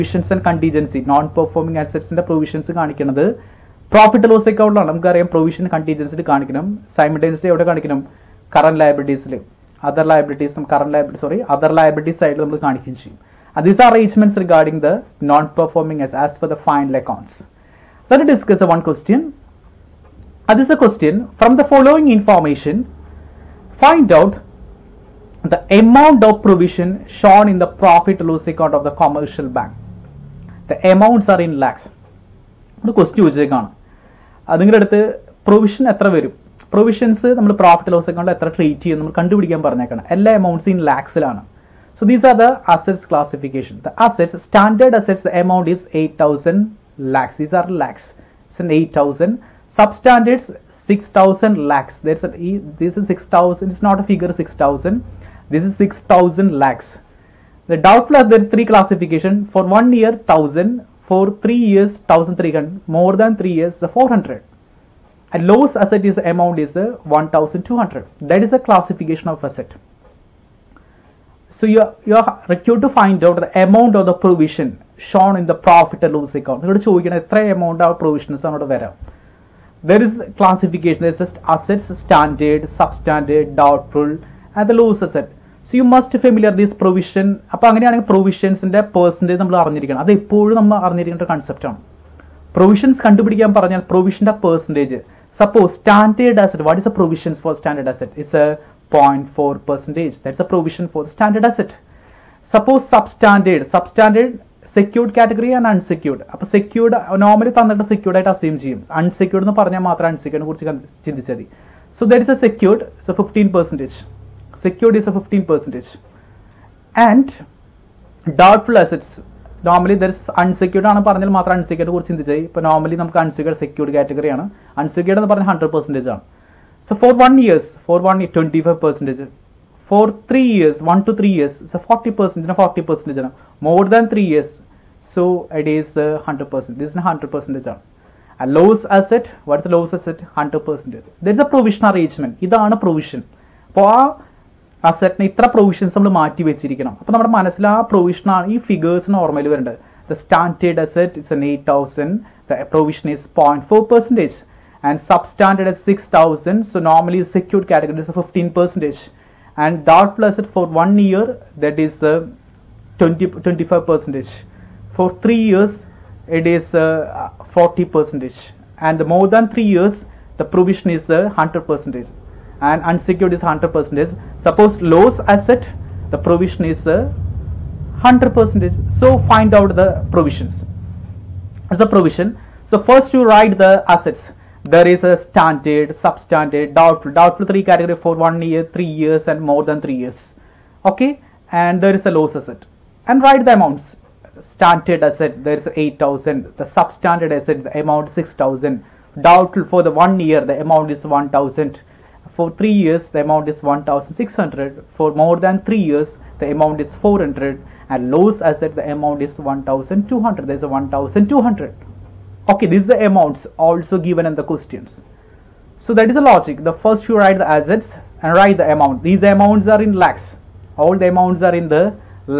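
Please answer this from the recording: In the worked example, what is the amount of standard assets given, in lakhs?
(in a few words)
8000.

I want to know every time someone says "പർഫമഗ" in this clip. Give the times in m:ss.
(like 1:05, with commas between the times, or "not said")
0:01, 0:15.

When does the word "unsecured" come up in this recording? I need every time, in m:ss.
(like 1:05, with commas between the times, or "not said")
2:52.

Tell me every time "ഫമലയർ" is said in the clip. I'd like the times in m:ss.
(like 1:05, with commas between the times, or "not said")
1:26.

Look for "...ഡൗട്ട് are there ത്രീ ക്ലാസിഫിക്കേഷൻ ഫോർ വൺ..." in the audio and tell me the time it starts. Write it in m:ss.
0:57.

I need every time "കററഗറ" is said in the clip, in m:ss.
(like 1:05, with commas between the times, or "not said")
1:45, 2:03, 2:37.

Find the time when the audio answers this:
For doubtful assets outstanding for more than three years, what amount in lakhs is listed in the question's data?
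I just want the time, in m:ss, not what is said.
1:02.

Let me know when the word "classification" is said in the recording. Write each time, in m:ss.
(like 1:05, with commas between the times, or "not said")
1:08, 1:20.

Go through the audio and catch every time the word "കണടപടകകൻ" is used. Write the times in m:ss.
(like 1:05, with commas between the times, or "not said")
0:39, 1:33.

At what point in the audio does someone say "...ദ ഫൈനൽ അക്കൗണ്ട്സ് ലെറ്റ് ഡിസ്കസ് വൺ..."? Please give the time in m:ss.
0:16.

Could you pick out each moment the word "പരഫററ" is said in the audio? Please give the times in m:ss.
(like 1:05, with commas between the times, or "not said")
0:03, 0:27, 0:37.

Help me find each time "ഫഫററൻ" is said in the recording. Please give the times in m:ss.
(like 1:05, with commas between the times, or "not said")
1:53, 2:38.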